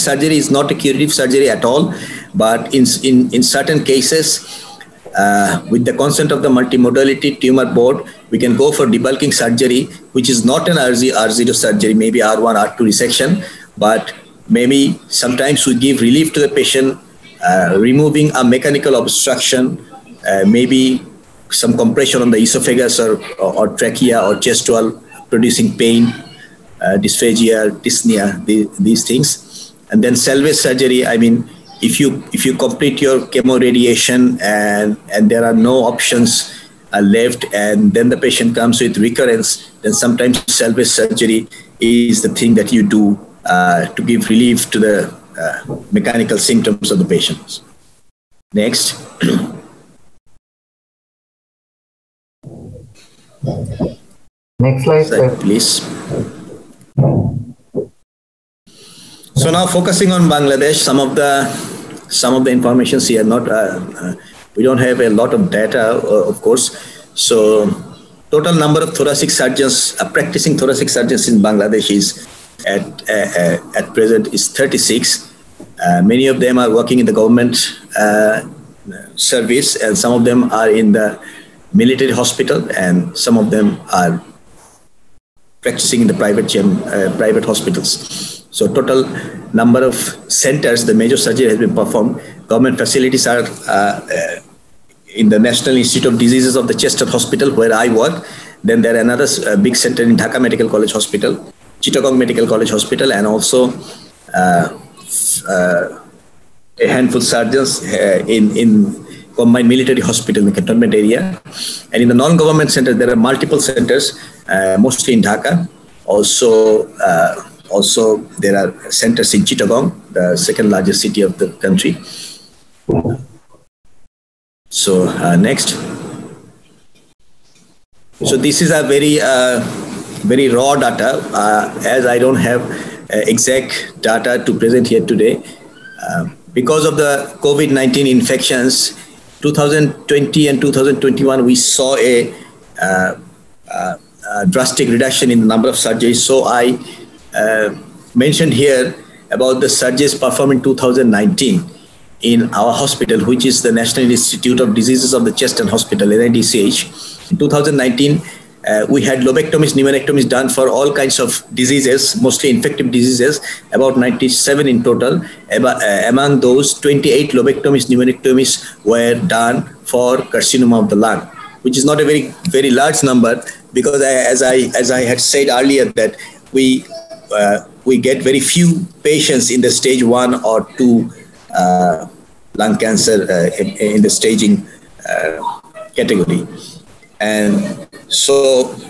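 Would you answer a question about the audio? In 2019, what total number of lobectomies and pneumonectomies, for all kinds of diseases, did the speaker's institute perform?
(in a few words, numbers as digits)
97.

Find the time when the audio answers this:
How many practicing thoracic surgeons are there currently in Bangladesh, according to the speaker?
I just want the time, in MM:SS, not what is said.
01:14.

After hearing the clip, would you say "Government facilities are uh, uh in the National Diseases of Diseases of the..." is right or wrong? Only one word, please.
wrong.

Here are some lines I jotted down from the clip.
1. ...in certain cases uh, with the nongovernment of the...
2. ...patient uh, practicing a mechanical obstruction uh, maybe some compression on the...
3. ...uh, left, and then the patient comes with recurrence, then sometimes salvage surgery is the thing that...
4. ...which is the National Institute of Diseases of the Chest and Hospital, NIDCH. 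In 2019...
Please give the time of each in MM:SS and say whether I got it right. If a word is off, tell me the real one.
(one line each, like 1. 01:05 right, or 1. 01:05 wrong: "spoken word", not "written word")
1. 00:03 wrong: "consent", not "nongovernment"
2. 00:16 wrong: "removing", not "practicing"
3. 00:36 right
4. 02:33 right.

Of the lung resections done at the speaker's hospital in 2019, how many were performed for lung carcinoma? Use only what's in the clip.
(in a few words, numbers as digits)
28.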